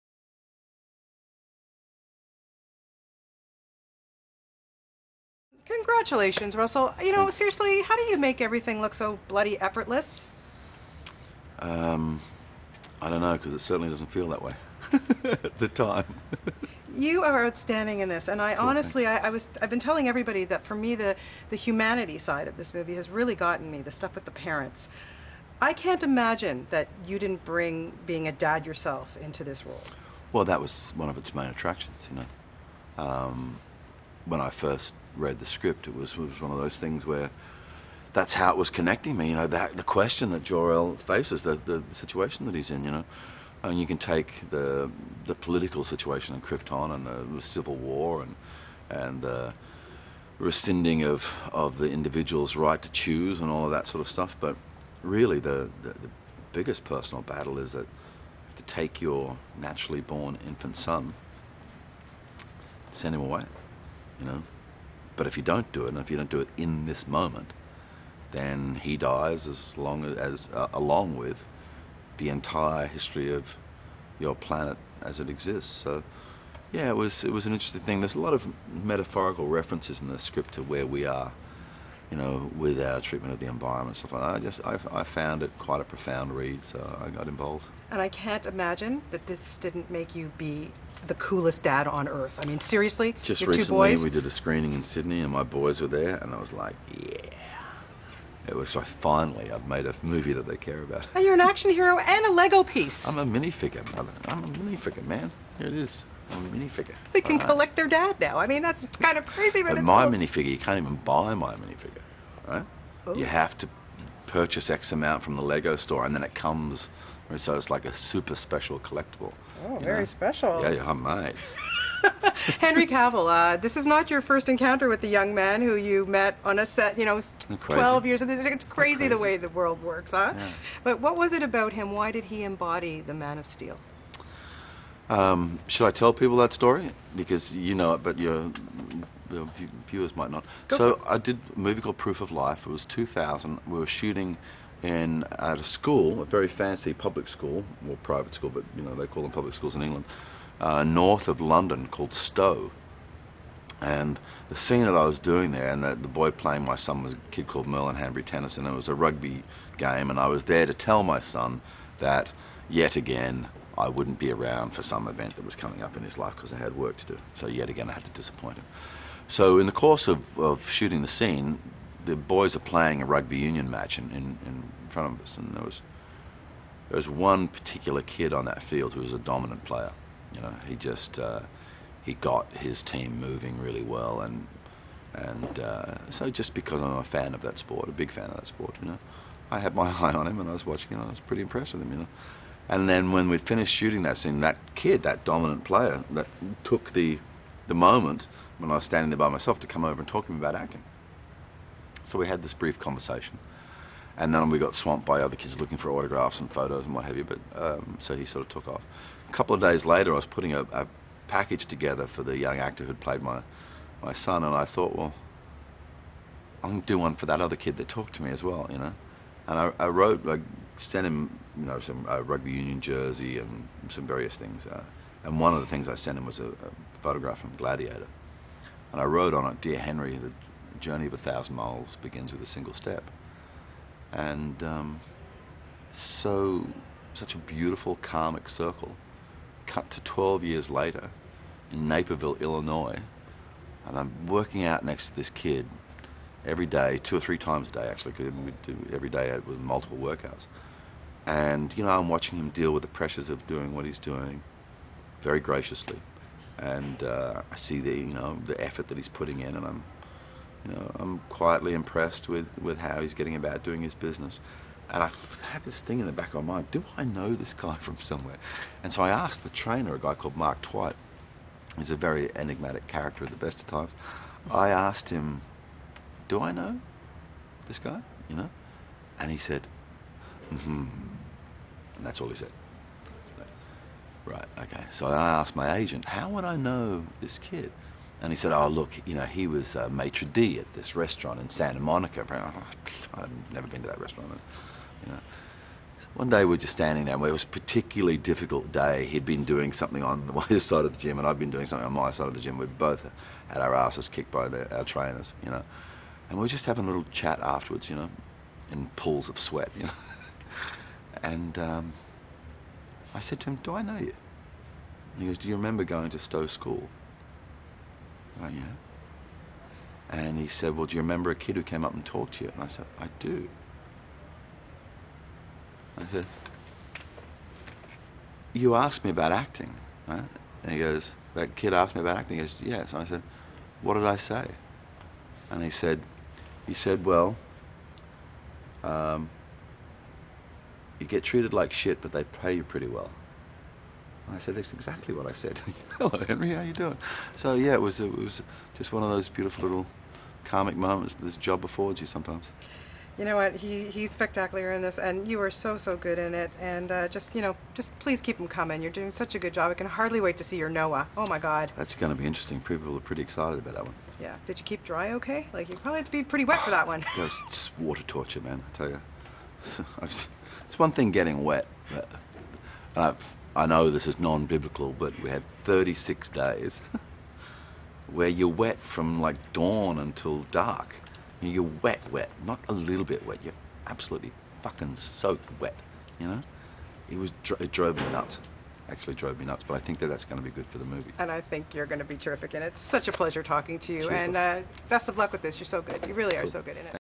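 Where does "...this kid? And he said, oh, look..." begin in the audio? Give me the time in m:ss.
4:47.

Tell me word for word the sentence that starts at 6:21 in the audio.
You're wet, wet, not a little bit wet.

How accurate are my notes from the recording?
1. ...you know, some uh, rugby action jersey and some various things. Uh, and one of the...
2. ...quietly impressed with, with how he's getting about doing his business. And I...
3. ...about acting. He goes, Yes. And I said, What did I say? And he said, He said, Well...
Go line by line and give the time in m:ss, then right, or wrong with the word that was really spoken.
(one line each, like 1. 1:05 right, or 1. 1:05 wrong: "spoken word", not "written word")
1. 3:41 wrong: "union", not "action"
2. 4:21 right
3. 5:32 right.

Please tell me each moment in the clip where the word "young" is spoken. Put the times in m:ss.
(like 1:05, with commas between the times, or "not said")
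2:05, 3:32.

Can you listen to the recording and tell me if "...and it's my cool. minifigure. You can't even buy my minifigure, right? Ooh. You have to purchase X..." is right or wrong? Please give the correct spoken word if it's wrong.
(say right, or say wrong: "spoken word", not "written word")
right.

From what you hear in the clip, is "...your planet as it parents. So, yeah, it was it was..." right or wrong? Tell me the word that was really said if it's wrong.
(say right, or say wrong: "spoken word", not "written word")
wrong: "exists", not "parents".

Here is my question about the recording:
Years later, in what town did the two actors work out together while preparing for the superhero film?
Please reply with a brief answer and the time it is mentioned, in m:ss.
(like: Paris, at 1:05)
Naperville, Illinois, at 4:01.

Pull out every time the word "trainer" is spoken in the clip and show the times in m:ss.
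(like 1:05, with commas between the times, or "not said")
4:29, 5:04.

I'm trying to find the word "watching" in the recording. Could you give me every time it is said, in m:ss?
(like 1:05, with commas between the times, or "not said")
3:10, 4:12.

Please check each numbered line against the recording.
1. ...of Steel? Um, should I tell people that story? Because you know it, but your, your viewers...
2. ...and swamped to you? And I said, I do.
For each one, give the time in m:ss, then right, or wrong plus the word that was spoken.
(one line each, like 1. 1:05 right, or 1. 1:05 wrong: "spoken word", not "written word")
1. 2:13 right
2. 5:21 wrong: "talked", not "swamped".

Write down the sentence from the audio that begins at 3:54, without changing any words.
And um, so, such a beautiful karmic circle.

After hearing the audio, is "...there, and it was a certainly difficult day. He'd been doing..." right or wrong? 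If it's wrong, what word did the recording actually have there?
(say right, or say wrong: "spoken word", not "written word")
wrong: "particularly", not "certainly".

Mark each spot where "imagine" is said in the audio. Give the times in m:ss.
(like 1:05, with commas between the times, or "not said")
0:26, 1:28.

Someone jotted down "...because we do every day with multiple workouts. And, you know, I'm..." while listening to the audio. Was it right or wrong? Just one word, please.
right.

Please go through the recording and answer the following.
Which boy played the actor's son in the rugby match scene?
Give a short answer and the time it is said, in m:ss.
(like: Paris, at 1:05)
Merlin Hanbury Tennyson, at 2:37.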